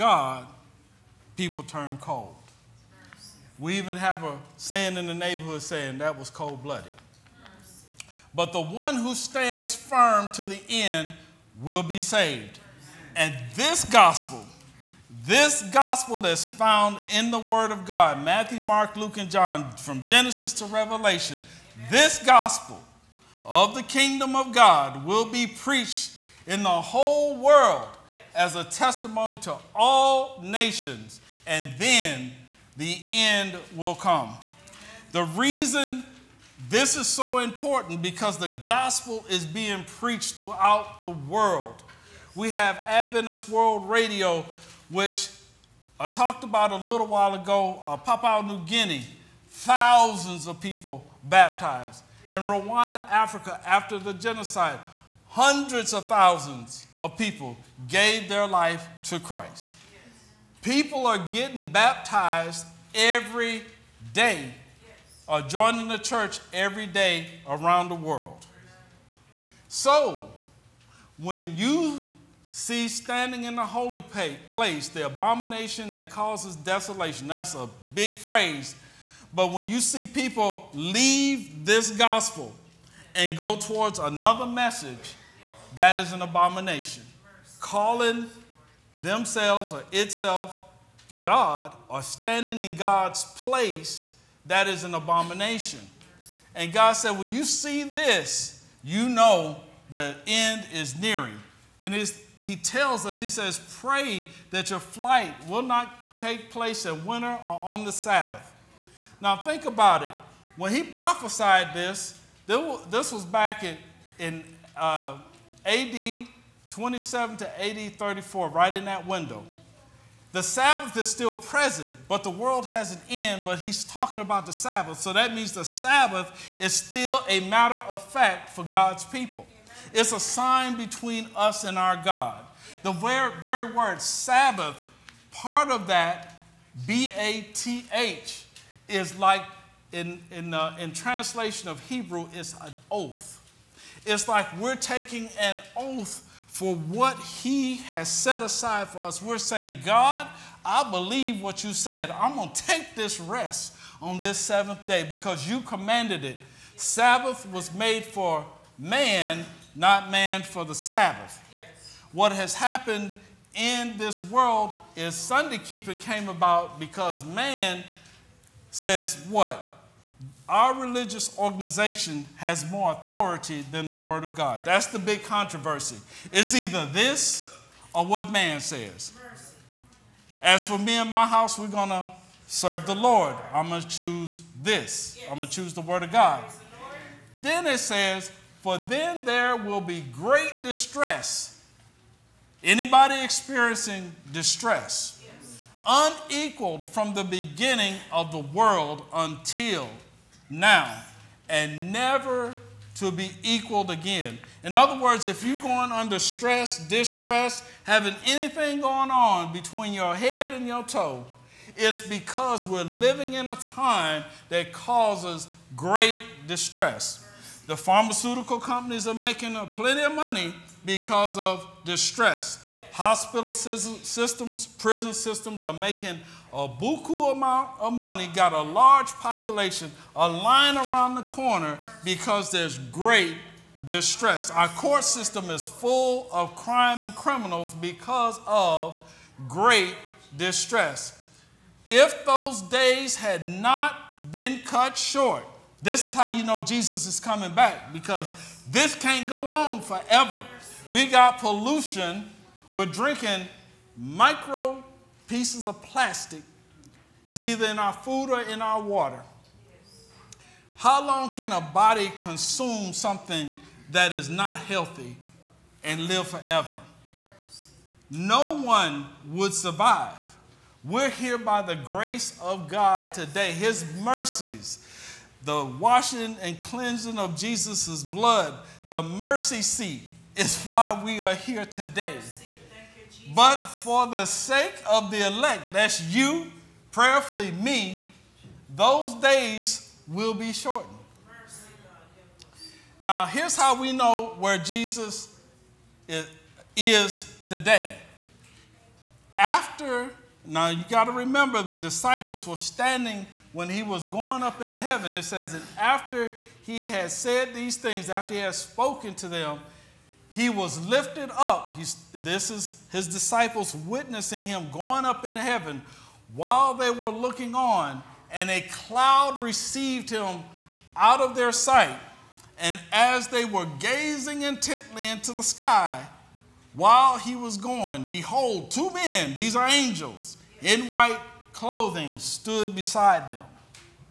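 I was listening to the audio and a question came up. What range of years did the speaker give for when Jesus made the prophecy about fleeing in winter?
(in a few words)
AD 27 to AD 34.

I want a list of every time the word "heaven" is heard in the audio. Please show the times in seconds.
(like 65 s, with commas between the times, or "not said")
304 s, 315 s.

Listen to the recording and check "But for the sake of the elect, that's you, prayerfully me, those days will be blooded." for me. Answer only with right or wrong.
wrong.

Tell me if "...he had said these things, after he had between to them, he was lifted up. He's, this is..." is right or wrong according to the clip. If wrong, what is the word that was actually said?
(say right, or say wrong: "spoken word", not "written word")
wrong: "spoken", not "between".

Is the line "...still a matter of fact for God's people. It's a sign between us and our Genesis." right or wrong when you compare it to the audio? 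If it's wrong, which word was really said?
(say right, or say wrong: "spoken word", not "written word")
wrong: "God", not "Genesis".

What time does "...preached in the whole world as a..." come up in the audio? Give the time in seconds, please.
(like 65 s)
25 s.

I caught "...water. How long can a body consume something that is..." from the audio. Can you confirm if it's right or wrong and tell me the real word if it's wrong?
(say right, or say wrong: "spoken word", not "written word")
right.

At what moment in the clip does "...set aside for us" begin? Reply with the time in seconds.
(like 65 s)
148 s.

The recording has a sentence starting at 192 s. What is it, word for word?
Anybody experiencing distress, unequaled from the beginning of the world until now and never to be equaled again.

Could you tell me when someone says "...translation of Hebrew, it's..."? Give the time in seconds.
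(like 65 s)
140 s.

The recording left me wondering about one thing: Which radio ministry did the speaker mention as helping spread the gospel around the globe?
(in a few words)
Adventist World Radio.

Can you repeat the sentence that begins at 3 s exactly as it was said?
We even have a saying in the neighborhood saying that was cold blooded.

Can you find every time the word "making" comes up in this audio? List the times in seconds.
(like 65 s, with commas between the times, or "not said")
219 s, 225 s.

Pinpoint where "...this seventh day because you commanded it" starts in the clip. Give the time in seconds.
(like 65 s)
154 s.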